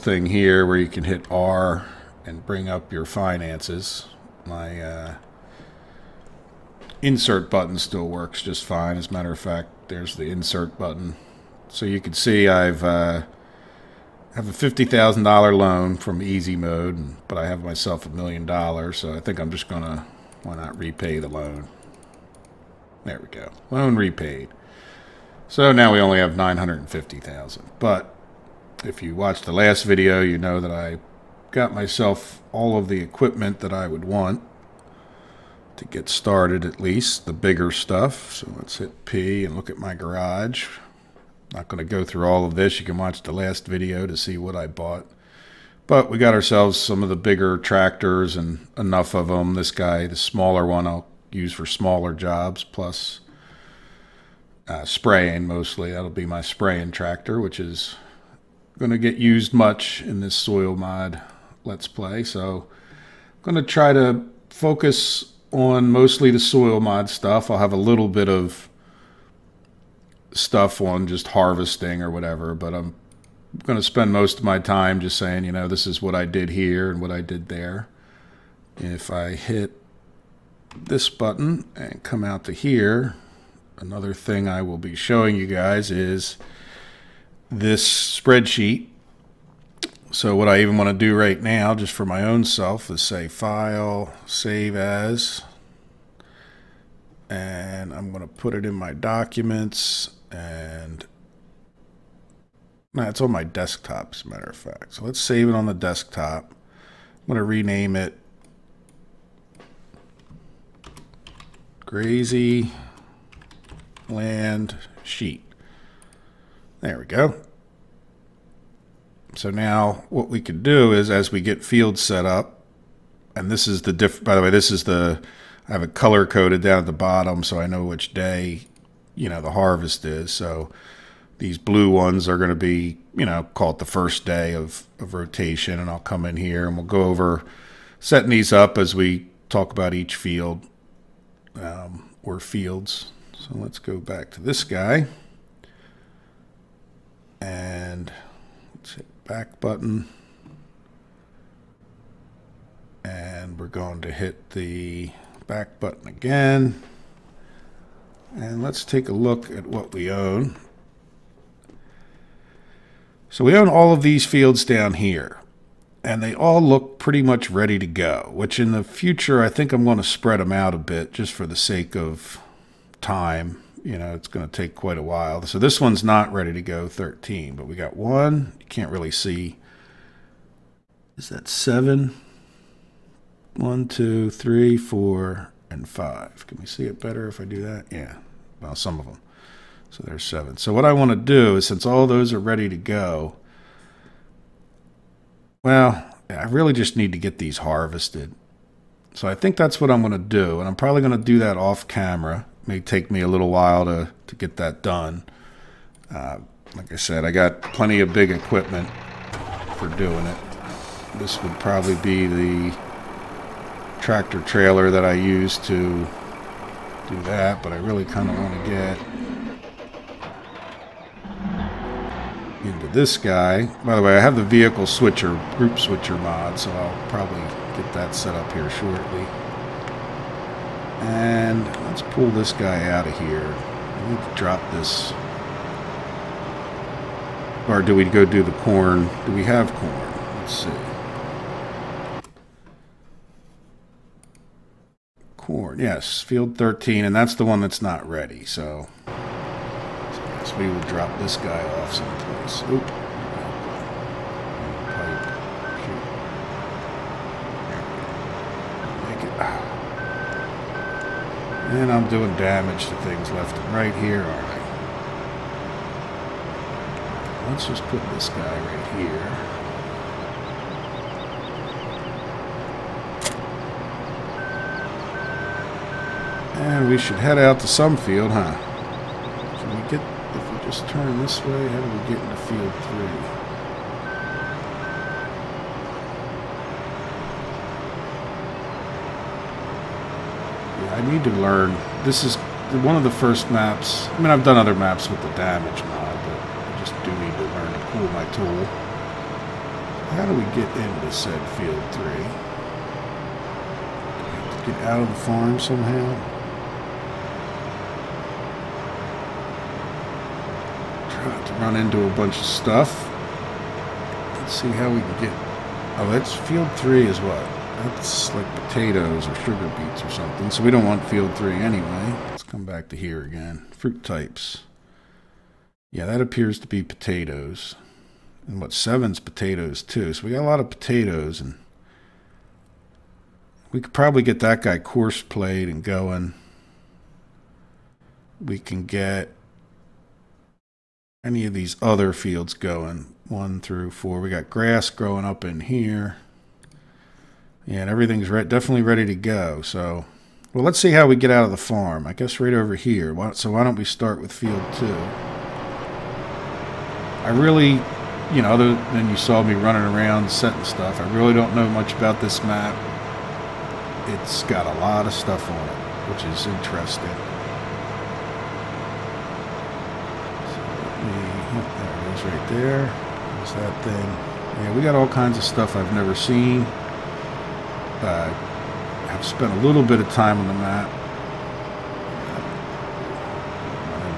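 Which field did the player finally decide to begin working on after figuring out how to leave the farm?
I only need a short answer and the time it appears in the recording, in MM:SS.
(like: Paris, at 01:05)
Field 2, at 05:54.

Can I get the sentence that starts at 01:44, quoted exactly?
So let's save it on the desktop.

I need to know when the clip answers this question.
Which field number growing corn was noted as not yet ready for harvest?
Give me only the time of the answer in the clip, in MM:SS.
04:06.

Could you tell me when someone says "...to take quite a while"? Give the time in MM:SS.
02:54.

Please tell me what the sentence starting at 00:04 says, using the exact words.
My uh, insert button still works just fine.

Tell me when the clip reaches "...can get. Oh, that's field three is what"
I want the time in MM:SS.
05:14.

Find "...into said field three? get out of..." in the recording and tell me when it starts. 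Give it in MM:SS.
05:00.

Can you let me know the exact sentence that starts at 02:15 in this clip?
And I'll come in here and we'll go over setting these up as we talk about each field um, or fields.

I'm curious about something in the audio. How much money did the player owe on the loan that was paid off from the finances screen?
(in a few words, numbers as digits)
$50,000.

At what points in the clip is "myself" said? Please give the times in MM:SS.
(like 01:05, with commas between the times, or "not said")
00:17, 00:31.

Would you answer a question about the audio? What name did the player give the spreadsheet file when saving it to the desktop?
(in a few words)
Grazy Land Sheet.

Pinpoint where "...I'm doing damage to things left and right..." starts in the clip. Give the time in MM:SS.
04:21.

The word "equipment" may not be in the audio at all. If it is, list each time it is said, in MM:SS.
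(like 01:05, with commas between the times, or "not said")
00:33, 03:28.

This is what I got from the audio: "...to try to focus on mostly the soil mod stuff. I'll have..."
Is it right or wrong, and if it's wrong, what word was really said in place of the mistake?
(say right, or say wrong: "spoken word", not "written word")
right.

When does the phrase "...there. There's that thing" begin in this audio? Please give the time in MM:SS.
06:12.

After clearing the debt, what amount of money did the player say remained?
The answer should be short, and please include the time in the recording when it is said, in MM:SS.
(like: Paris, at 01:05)
$950,000, at 00:26.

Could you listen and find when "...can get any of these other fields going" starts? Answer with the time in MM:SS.
05:38.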